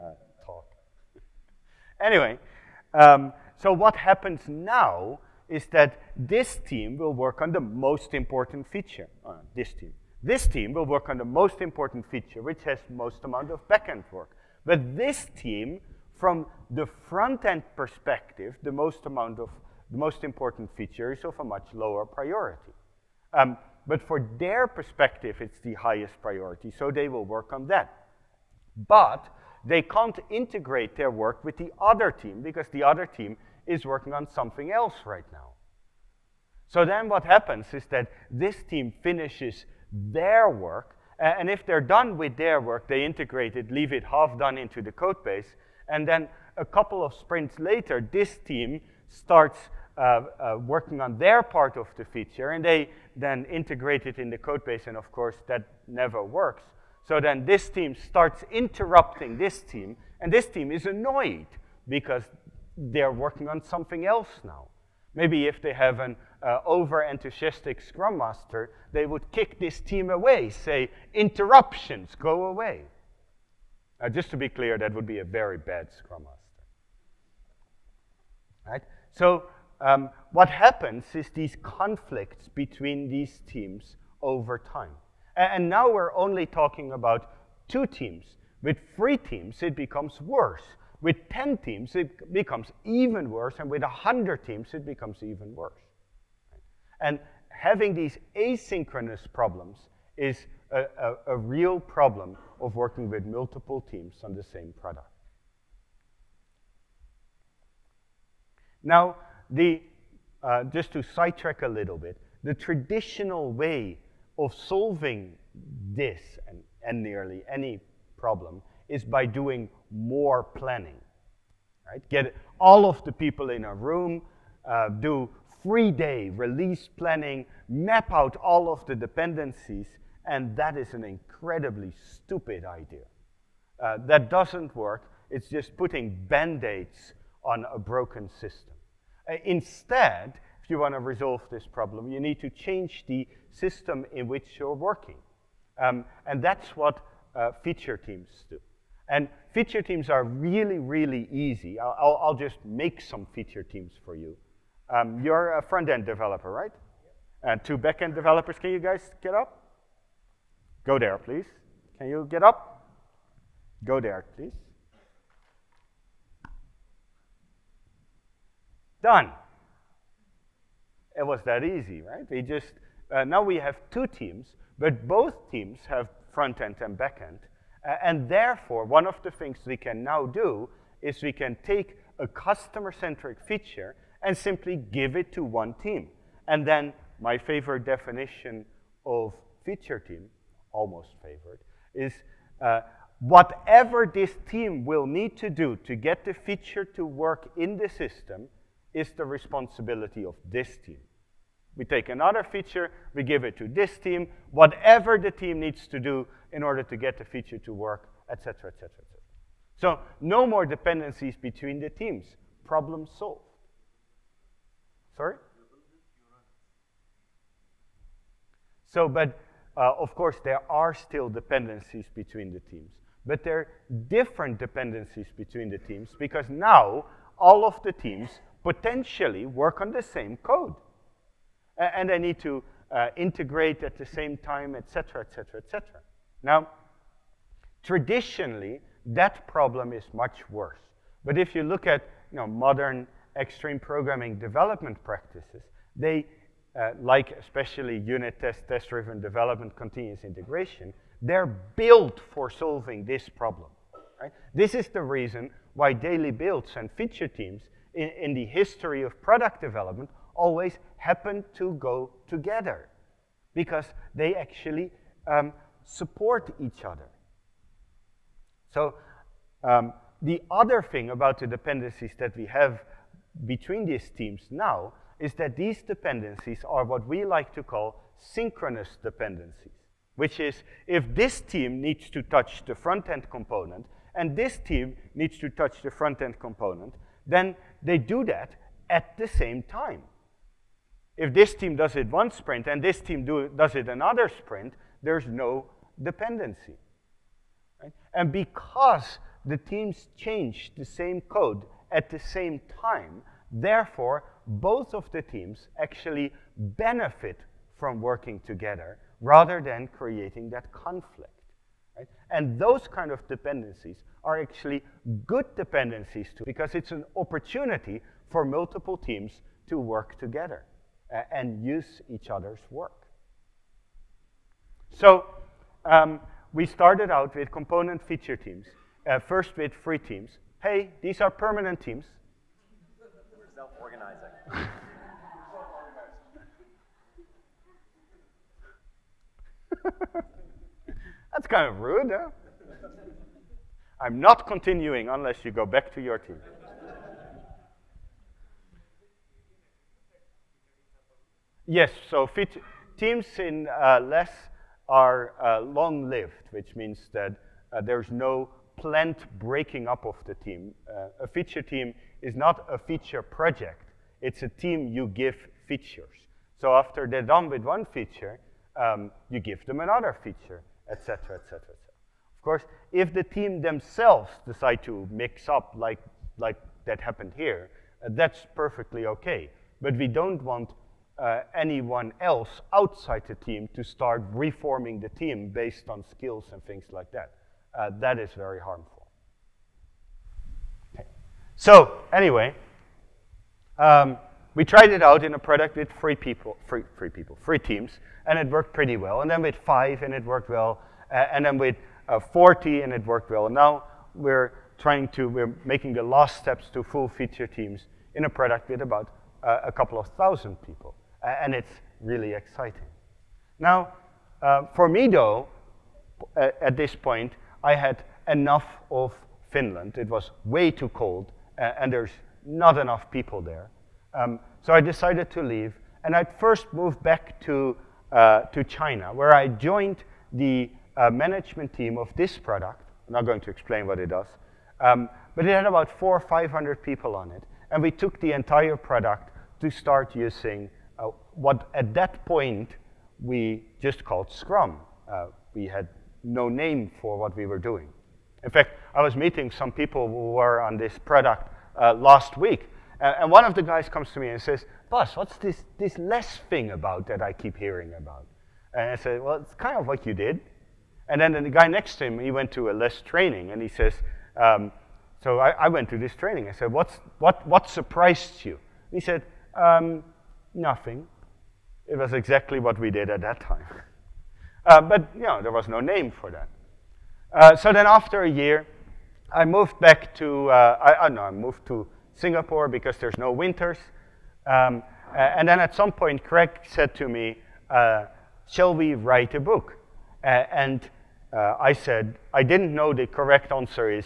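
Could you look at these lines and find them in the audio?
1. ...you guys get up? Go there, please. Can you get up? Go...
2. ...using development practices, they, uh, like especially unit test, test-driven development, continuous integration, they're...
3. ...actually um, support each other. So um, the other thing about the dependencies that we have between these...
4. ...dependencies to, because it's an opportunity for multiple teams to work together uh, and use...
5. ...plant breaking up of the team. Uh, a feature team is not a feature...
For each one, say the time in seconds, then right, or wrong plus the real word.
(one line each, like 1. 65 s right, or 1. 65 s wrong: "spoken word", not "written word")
1. 158 s right
2. 243 s wrong: "programming", not "using"
3. 264 s right
4. 315 s right
5. 358 s right.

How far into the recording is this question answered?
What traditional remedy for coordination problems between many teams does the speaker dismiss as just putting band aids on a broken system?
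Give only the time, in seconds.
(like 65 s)
119 s.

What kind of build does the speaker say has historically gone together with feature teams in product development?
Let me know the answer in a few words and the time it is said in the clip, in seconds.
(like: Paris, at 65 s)
Daily builds, at 255 s.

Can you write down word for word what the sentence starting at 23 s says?
Um, but for their perspective, it's the highest priority, so they will work on that.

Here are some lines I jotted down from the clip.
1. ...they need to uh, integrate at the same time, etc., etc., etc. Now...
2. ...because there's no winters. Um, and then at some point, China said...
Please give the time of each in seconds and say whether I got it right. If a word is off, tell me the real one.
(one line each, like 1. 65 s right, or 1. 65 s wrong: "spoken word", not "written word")
1. 232 s right
2. 482 s wrong: "Craig", not "China".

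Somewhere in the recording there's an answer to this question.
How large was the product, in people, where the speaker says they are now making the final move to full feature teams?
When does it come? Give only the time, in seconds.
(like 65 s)
409 s.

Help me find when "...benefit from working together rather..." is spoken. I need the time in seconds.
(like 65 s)
306 s.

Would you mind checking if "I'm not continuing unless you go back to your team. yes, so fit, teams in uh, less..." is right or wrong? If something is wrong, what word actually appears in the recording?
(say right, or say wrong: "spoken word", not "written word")
right.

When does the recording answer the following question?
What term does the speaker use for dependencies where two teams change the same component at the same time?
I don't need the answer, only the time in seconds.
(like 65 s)
278 s.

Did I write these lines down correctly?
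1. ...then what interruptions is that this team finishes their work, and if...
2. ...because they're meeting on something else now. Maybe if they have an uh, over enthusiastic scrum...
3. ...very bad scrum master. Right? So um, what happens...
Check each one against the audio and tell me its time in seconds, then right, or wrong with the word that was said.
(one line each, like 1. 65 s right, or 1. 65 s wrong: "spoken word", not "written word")
1. 36 s wrong: "happens", not "interruptions"
2. 61 s wrong: "working", not "meeting"
3. 75 s right.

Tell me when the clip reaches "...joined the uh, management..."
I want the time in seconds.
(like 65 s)
429 s.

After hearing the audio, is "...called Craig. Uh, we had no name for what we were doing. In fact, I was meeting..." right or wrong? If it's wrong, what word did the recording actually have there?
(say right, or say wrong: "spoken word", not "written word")
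wrong: "Scrum", not "Craig".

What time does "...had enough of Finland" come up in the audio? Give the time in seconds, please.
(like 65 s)
417 s.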